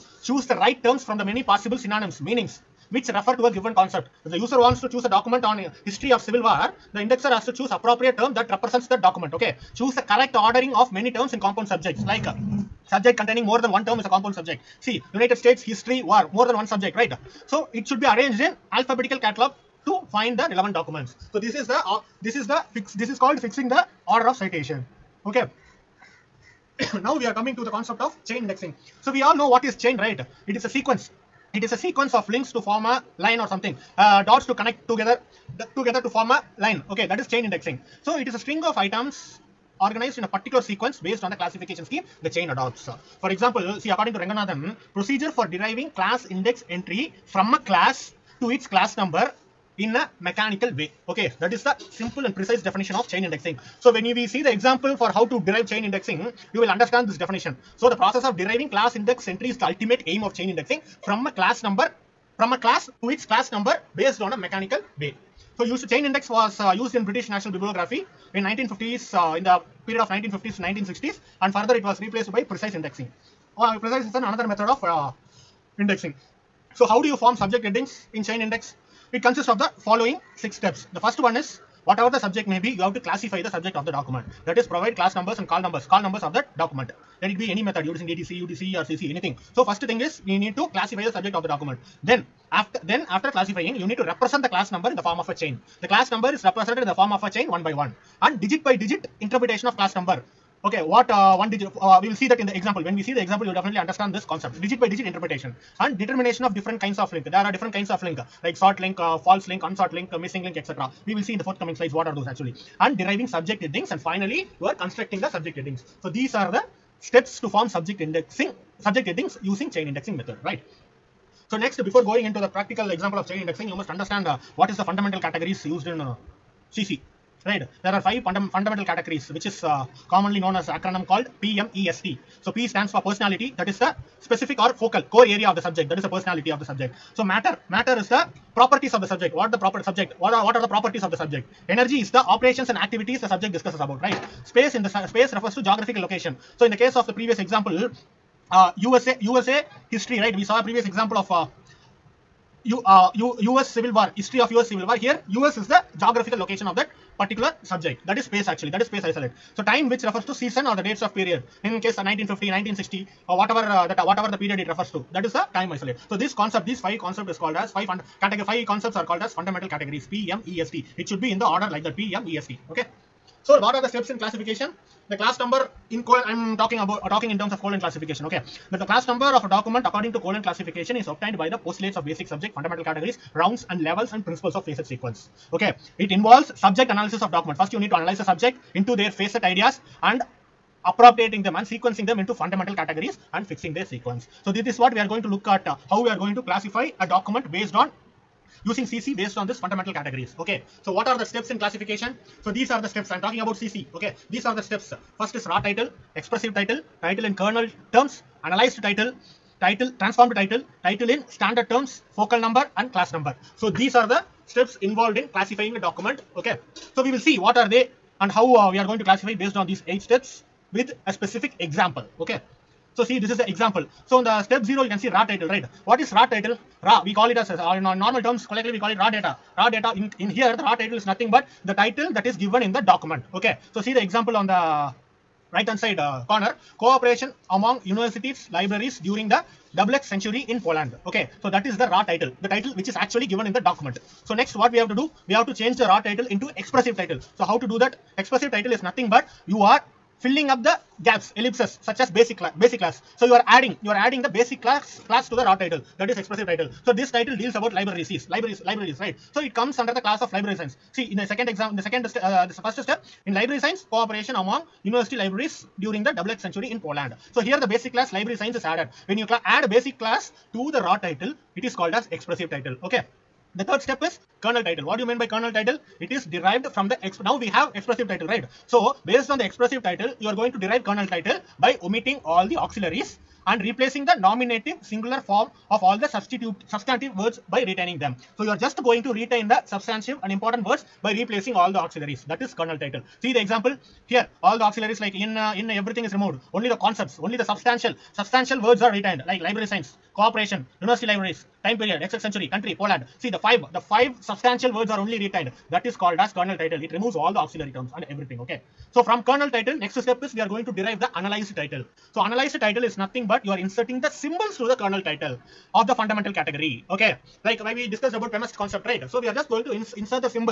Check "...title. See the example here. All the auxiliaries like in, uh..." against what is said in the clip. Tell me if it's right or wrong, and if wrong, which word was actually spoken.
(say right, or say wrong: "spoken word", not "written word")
right.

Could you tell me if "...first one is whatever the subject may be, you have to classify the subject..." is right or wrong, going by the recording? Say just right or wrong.
right.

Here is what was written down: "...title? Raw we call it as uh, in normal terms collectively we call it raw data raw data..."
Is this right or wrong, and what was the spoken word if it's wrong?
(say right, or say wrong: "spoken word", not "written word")
right.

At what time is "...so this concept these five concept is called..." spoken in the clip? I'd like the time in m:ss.
2:46.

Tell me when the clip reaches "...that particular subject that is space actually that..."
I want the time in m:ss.
2:36.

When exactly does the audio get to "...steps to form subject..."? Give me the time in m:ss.
1:56.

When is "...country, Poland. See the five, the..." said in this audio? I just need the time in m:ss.
5:02.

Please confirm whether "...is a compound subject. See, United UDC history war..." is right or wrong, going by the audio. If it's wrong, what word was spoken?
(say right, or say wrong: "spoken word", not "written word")
wrong: "States", not "UDC".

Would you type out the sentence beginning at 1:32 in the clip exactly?
Then after then after classifying you need to represent the class number in the form of a chain.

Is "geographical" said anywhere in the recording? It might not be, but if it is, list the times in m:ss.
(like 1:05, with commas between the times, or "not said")
2:25, 2:35.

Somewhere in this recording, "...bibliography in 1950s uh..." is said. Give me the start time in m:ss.
1:07.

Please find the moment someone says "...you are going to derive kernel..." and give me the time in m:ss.
4:40.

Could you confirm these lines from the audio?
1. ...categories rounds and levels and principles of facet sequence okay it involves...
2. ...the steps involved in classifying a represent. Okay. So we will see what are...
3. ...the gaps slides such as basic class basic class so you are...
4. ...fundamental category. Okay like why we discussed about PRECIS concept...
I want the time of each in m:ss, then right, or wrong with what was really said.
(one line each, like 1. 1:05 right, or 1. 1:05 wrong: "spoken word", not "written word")
1. 3:02 right
2. 3:34 wrong: "document", not "represent"
3. 4:10 wrong: "ellipses", not "slides"
4. 5:16 wrong: "PMEST", not "PRECIS".